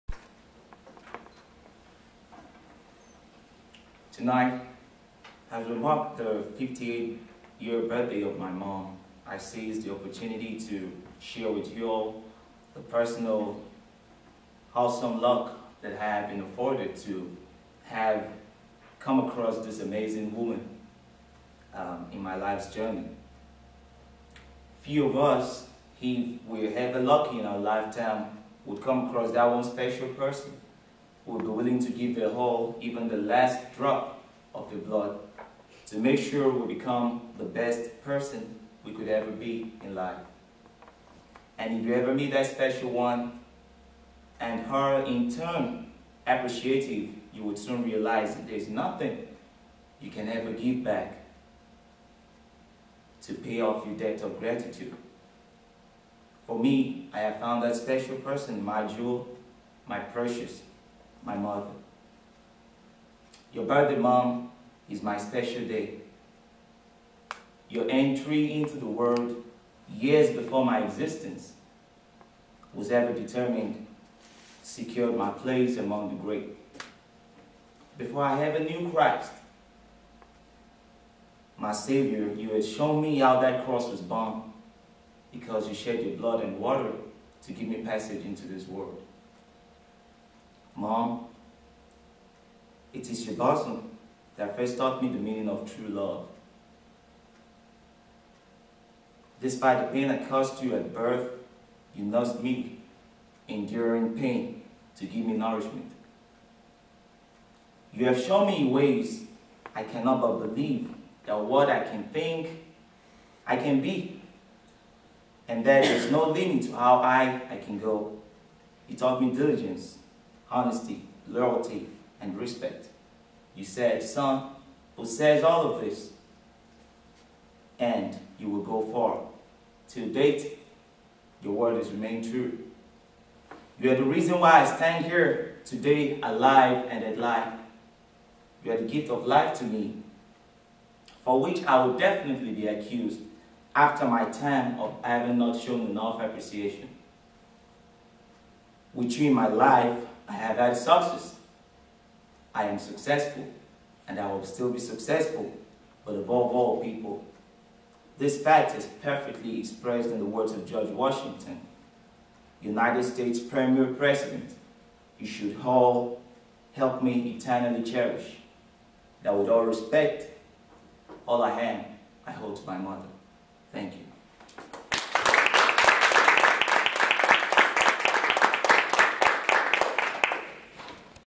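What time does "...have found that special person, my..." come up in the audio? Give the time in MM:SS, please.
00:57.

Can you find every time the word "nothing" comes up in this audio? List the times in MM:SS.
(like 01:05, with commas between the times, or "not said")
00:48.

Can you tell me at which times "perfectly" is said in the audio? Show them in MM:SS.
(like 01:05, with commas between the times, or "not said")
02:39.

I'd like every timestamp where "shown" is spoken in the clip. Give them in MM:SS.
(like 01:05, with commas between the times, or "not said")
01:22, 01:48, 02:25.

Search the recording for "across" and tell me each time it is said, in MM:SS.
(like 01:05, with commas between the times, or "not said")
00:19, 00:29.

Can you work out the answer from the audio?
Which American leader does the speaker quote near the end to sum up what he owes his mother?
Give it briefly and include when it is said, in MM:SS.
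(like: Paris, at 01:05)
George Washington, at 02:40.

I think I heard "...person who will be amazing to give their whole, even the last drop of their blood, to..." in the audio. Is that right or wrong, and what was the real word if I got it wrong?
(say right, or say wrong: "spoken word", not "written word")
wrong: "willing", not "amazing".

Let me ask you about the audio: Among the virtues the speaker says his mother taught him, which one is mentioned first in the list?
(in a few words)
diligence.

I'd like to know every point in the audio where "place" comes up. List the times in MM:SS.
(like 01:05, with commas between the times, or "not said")
01:15.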